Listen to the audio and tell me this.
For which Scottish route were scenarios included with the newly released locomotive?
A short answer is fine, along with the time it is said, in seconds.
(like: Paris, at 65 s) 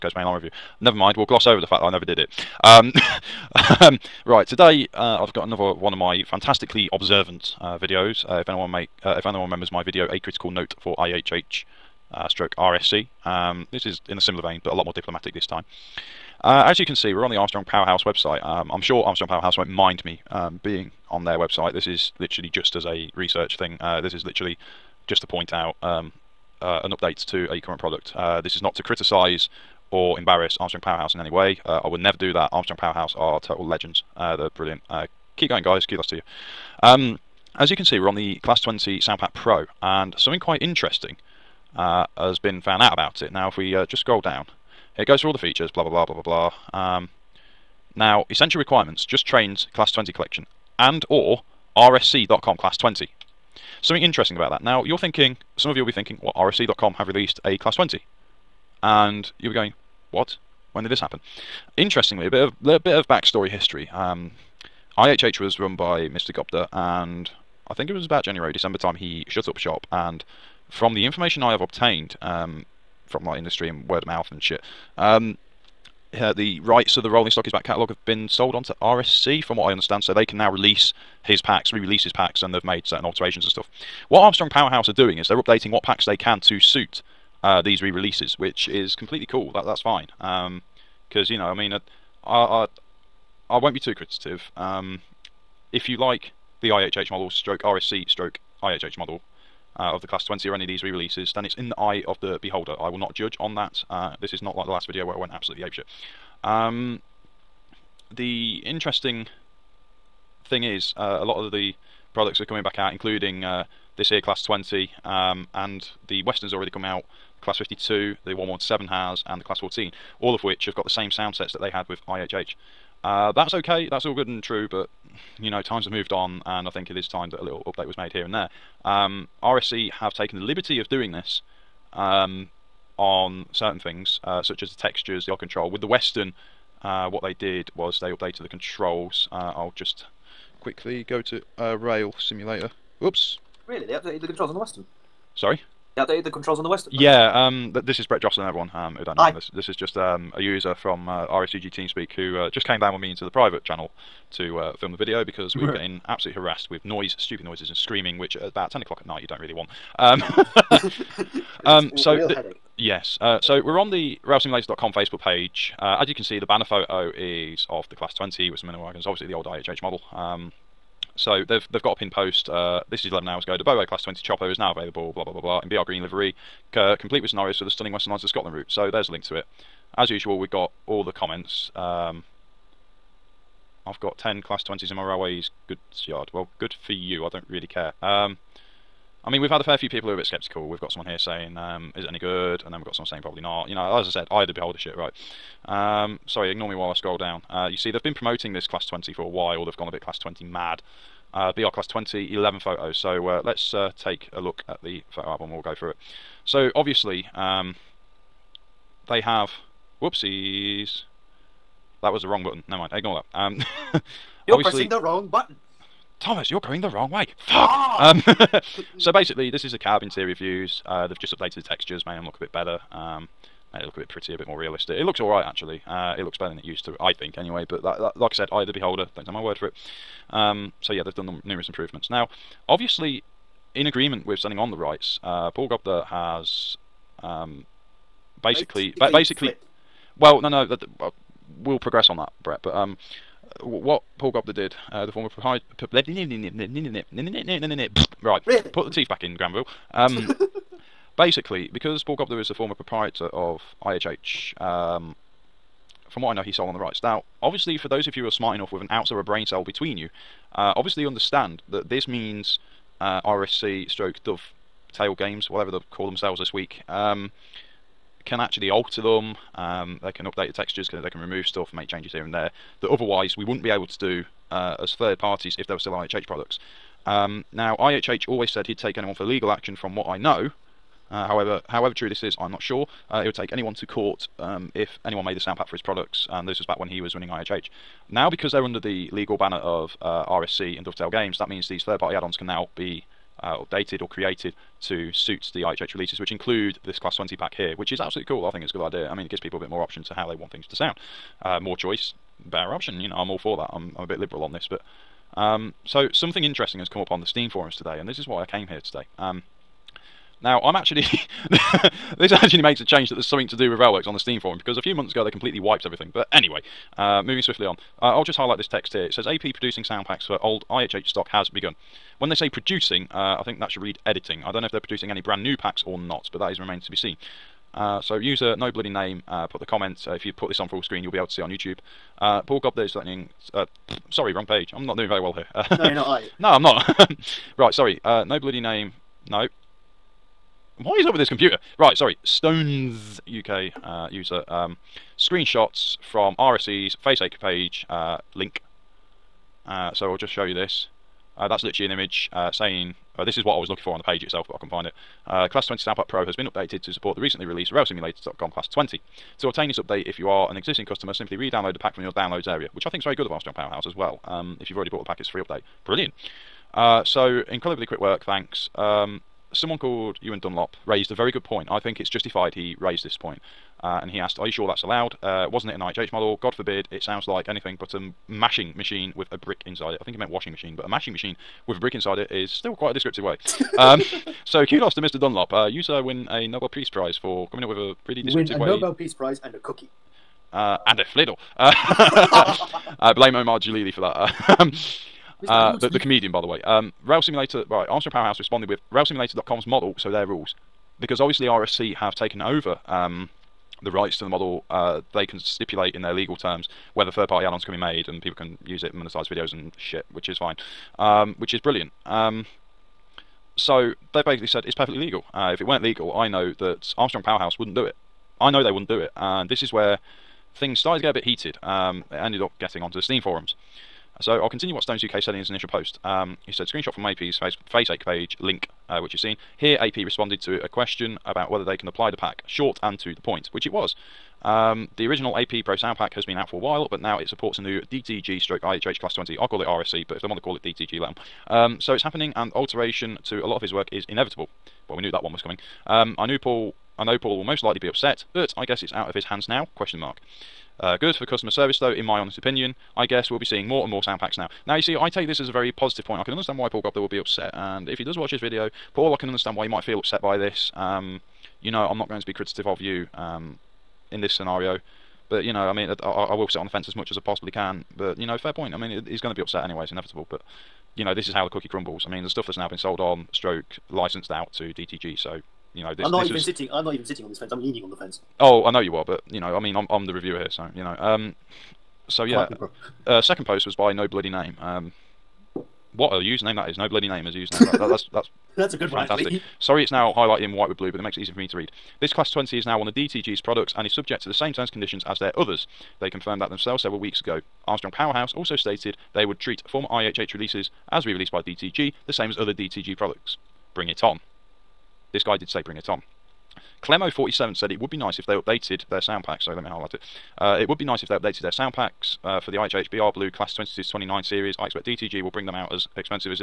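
Western Lines of Scotland, at 177 s.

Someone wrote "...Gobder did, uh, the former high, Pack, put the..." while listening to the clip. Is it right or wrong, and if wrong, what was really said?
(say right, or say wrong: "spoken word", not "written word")
wrong: "Right", not "Pack".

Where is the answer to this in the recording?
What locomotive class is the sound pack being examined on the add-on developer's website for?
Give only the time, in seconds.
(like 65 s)
38 s.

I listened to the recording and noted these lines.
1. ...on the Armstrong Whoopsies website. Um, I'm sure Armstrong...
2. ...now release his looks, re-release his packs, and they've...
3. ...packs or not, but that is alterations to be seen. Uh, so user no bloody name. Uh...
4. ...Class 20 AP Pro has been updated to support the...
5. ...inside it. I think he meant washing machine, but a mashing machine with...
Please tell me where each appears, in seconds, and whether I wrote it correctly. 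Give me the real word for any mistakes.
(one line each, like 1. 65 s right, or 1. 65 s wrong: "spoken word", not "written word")
1. 17 s wrong: "Powerhouse", not "Whoopsies"
2. 80 s wrong: "packs", not "looks"
3. 325 s wrong: "remains", not "alterations"
4. 355 s right
5. 379 s right.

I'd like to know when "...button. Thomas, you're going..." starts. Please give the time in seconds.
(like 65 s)
215 s.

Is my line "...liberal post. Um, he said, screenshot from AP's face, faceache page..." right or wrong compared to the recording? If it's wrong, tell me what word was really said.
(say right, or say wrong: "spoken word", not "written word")
wrong: "initial", not "liberal".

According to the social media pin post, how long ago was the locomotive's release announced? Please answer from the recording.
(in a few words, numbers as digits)
11 hours ago.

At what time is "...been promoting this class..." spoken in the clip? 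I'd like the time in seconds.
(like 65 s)
198 s.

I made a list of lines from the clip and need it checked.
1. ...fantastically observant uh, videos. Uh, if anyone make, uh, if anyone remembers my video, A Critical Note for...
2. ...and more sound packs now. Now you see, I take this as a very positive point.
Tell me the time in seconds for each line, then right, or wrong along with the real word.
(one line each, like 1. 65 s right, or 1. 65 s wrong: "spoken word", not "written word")
1. 6 s right
2. 453 s right.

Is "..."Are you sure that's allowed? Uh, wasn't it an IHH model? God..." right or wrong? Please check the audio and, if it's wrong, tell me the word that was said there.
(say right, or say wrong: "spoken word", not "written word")
right.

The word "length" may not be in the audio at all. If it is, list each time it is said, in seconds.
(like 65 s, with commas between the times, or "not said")
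not said.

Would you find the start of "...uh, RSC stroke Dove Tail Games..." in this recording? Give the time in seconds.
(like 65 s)
263 s.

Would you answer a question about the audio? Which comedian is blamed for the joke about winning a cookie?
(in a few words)
Omid Djalili.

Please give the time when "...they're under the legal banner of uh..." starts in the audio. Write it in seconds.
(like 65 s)
288 s.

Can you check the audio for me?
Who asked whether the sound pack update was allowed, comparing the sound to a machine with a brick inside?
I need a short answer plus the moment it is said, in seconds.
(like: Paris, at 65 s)
Ewan Dunlop, at 370 s.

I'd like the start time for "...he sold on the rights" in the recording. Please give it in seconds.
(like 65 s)
256 s.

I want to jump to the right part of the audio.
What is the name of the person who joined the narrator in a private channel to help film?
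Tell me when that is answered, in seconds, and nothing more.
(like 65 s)
148 s.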